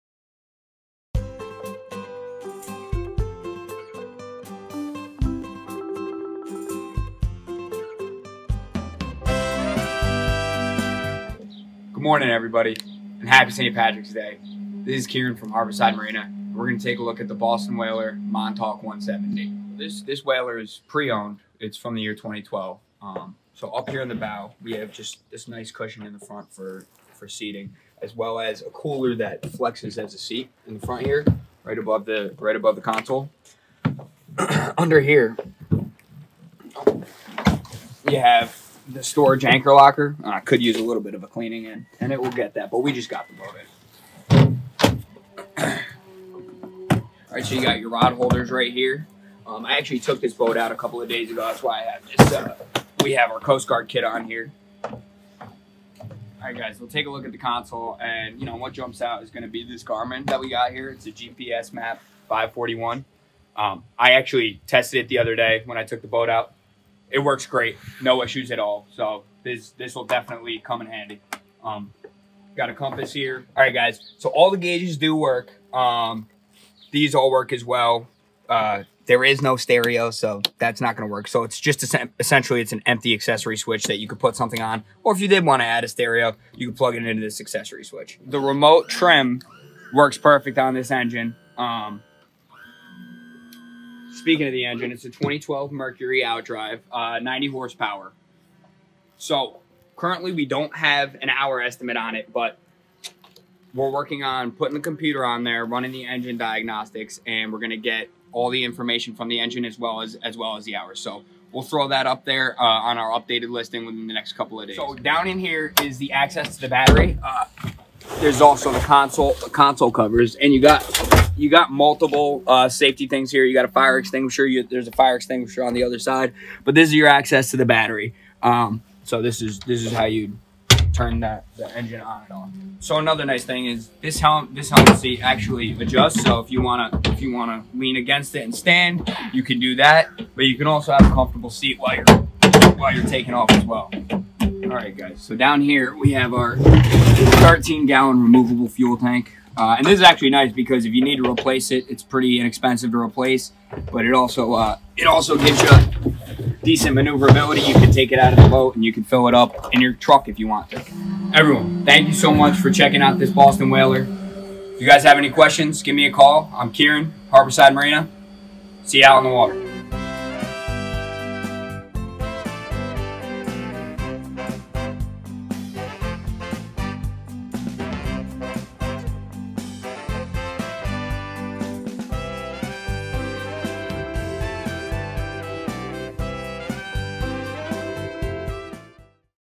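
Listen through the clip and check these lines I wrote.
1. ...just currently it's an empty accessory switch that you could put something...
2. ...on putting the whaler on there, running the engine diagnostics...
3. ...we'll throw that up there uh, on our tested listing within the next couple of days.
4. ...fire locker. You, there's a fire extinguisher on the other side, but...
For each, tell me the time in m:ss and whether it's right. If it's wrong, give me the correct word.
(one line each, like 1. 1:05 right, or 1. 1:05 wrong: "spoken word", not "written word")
1. 1:21 wrong: "essentially", not "currently"
2. 1:44 wrong: "computer", not "whaler"
3. 1:51 wrong: "updated", not "tested"
4. 2:03 wrong: "extinguisher", not "locker".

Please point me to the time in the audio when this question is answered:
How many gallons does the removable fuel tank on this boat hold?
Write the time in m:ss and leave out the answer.
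2:26.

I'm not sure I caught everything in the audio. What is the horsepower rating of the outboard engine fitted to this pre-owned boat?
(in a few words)
90.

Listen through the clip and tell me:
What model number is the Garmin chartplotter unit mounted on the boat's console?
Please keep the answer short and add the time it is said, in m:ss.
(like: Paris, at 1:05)
GPS map 541, at 1:01.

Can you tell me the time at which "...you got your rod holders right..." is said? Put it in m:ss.
0:47.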